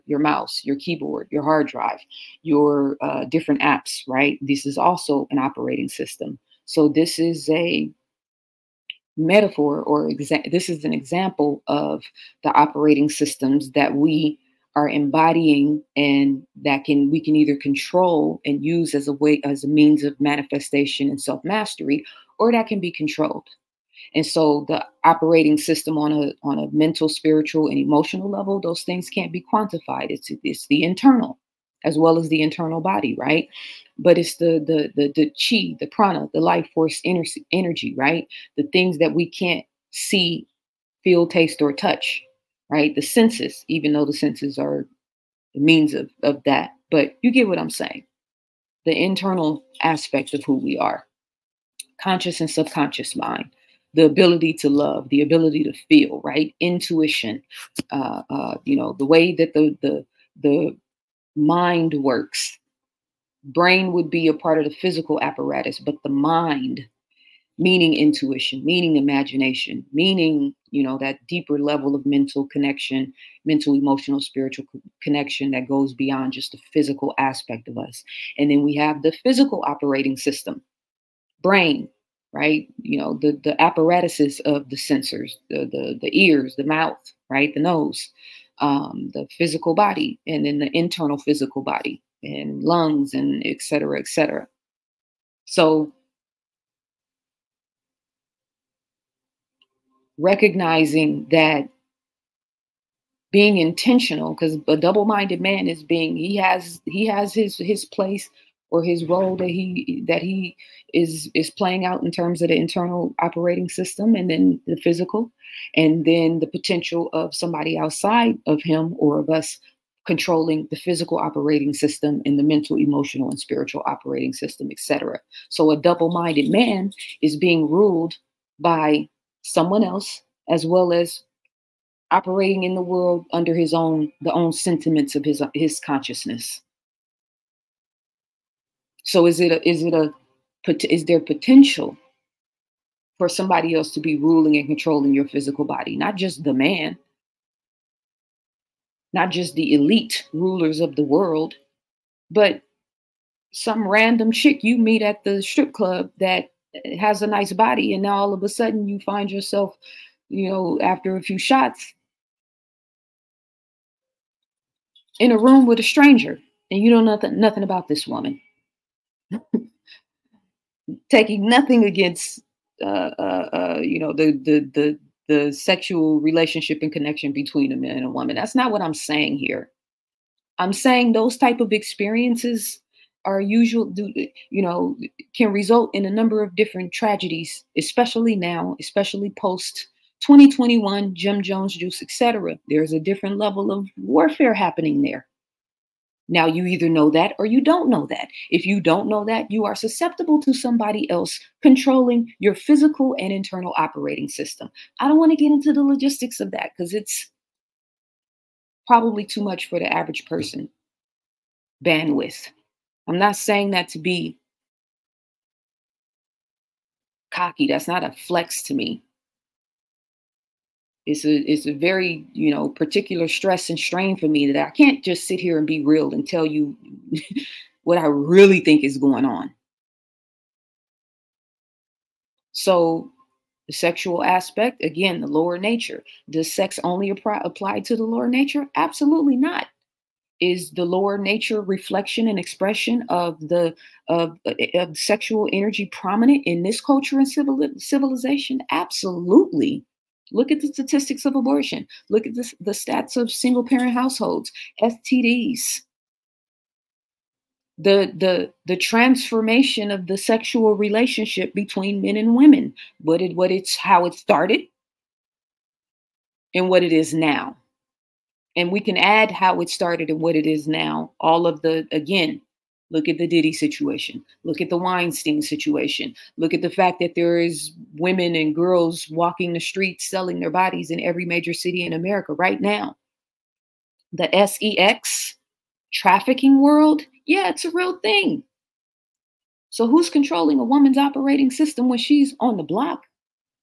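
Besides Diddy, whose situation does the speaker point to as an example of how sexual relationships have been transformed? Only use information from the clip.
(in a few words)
Weinstein.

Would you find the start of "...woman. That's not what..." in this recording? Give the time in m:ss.
2:58.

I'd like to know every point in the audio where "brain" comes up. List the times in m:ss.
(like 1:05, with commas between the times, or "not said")
1:03, 1:21.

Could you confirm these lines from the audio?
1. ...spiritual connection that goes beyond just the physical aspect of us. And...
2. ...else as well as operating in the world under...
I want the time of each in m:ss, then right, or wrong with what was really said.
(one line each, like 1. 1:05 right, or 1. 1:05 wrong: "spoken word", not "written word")
1. 1:14 right
2. 2:09 right.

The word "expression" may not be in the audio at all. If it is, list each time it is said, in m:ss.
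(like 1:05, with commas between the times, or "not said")
4:02.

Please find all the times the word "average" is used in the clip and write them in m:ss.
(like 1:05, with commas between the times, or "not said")
3:29.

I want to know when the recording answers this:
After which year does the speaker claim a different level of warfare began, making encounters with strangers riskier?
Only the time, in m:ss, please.
3:10.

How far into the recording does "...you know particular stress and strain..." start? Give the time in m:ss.
3:42.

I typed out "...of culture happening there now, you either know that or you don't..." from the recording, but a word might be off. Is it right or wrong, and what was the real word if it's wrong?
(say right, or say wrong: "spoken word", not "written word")
wrong: "warfare", not "culture".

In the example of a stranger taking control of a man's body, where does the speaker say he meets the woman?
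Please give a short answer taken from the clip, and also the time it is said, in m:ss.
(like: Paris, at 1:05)
strip club, at 2:35.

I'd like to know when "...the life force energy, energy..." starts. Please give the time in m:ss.
0:36.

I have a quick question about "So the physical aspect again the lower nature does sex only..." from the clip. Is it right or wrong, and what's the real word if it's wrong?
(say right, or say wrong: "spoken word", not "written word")
wrong: "sexual", not "physical".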